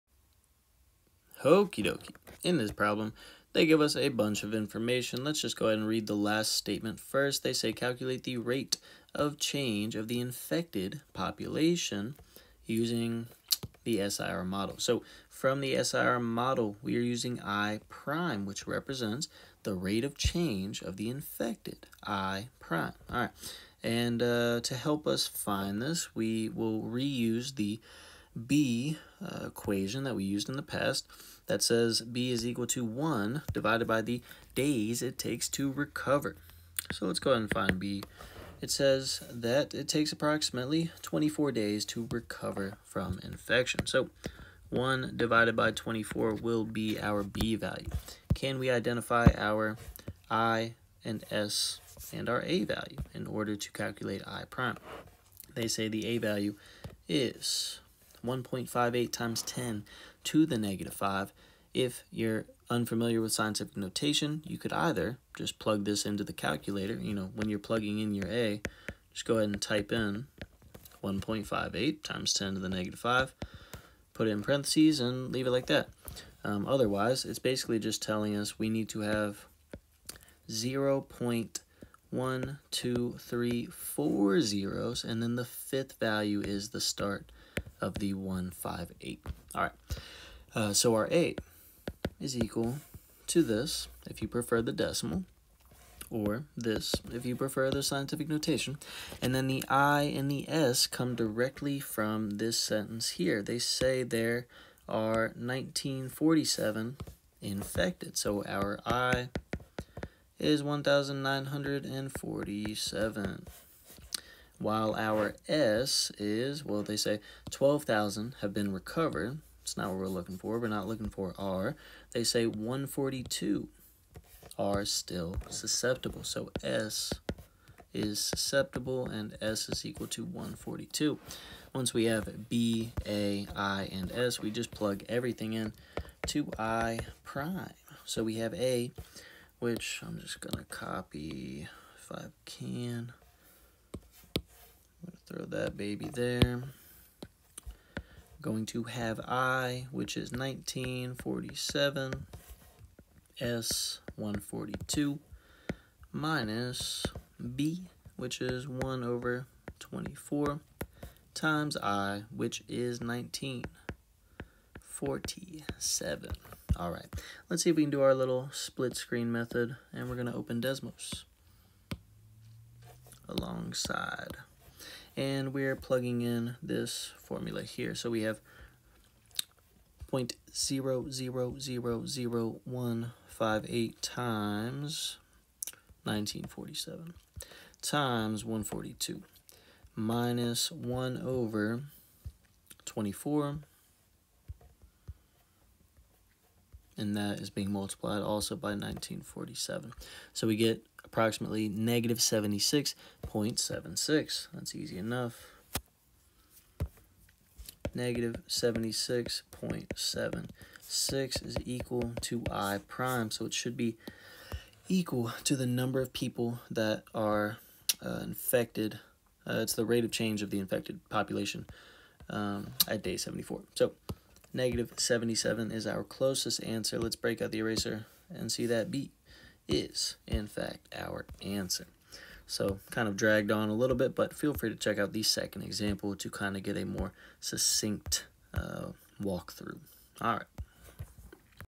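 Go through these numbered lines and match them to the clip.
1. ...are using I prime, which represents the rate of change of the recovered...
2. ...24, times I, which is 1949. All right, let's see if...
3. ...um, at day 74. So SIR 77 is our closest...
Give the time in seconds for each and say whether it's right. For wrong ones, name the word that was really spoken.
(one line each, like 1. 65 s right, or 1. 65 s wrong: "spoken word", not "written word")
1. 16 s wrong: "infected", not "recovered"
2. 159 s wrong: "1947", not "1949"
3. 222 s wrong: "Negative", not "SIR".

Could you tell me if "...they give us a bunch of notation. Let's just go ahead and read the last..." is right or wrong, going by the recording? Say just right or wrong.
wrong.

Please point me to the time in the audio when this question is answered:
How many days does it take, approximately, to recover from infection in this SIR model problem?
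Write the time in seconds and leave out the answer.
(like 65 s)
41 s.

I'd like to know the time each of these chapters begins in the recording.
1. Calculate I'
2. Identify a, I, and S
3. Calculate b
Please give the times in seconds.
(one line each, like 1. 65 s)
1. 136 s
2. 45 s
3. 18 s.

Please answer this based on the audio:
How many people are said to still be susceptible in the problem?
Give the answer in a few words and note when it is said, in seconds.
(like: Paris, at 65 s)
142, at 122 s.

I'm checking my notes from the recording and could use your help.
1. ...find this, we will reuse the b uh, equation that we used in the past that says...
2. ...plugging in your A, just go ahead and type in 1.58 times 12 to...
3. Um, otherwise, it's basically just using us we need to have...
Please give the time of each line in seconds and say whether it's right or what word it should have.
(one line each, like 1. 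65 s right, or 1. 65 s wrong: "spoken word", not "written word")
1. 25 s right
2. 67 s wrong: "10", not "12"
3. 76 s wrong: "telling", not "using".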